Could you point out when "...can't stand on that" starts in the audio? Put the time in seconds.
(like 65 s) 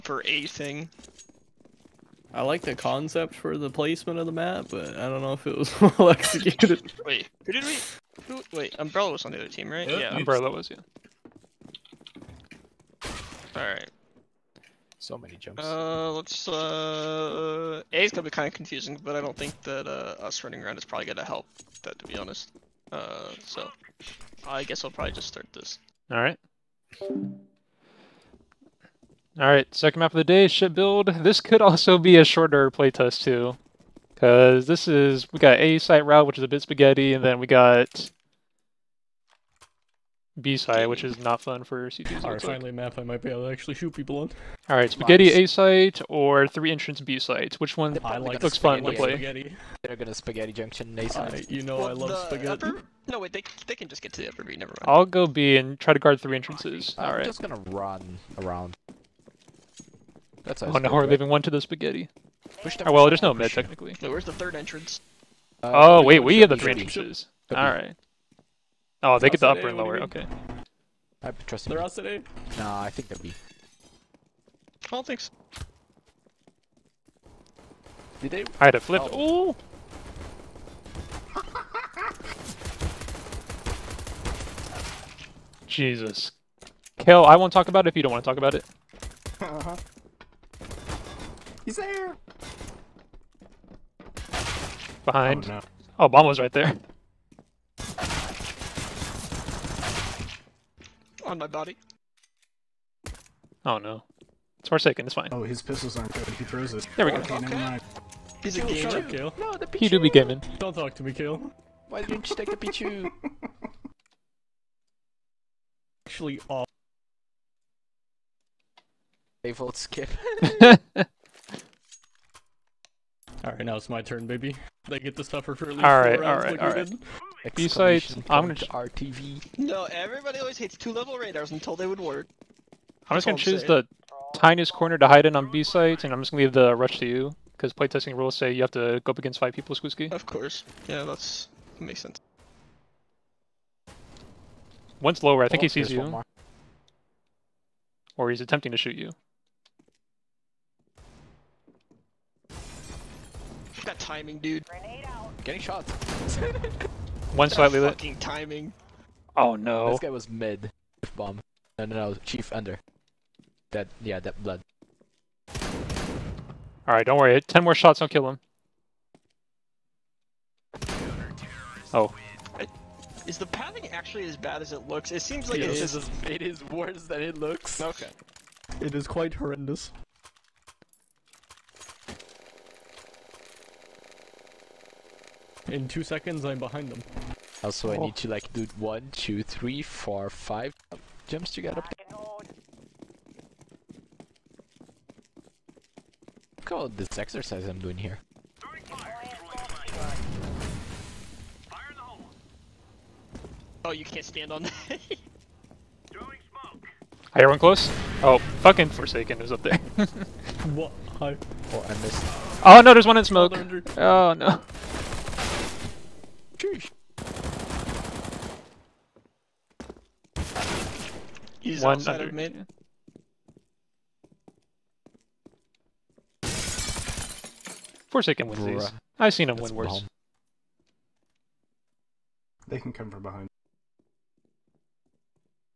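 204 s.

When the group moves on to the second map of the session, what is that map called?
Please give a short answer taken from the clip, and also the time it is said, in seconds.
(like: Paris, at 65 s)
ship build, at 30 s.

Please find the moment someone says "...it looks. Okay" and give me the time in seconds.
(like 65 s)
177 s.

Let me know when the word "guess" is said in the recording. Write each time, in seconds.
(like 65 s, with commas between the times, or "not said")
24 s.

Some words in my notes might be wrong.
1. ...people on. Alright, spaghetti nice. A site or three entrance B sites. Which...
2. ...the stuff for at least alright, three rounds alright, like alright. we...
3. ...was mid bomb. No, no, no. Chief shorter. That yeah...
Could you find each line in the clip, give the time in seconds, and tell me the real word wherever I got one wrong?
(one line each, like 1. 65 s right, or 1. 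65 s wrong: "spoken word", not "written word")
1. 43 s right
2. 125 s wrong: "four", not "three"
3. 160 s wrong: "under", not "shorter".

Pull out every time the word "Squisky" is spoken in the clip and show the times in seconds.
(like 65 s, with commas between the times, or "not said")
139 s.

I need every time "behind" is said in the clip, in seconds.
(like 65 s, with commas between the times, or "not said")
95 s, 186 s, 233 s.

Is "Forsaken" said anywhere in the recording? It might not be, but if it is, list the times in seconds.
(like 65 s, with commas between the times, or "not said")
104 s, 208 s, 228 s.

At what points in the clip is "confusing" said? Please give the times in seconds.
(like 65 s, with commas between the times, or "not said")
18 s.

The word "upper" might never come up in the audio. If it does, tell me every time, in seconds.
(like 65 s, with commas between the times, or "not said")
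54 s, 69 s.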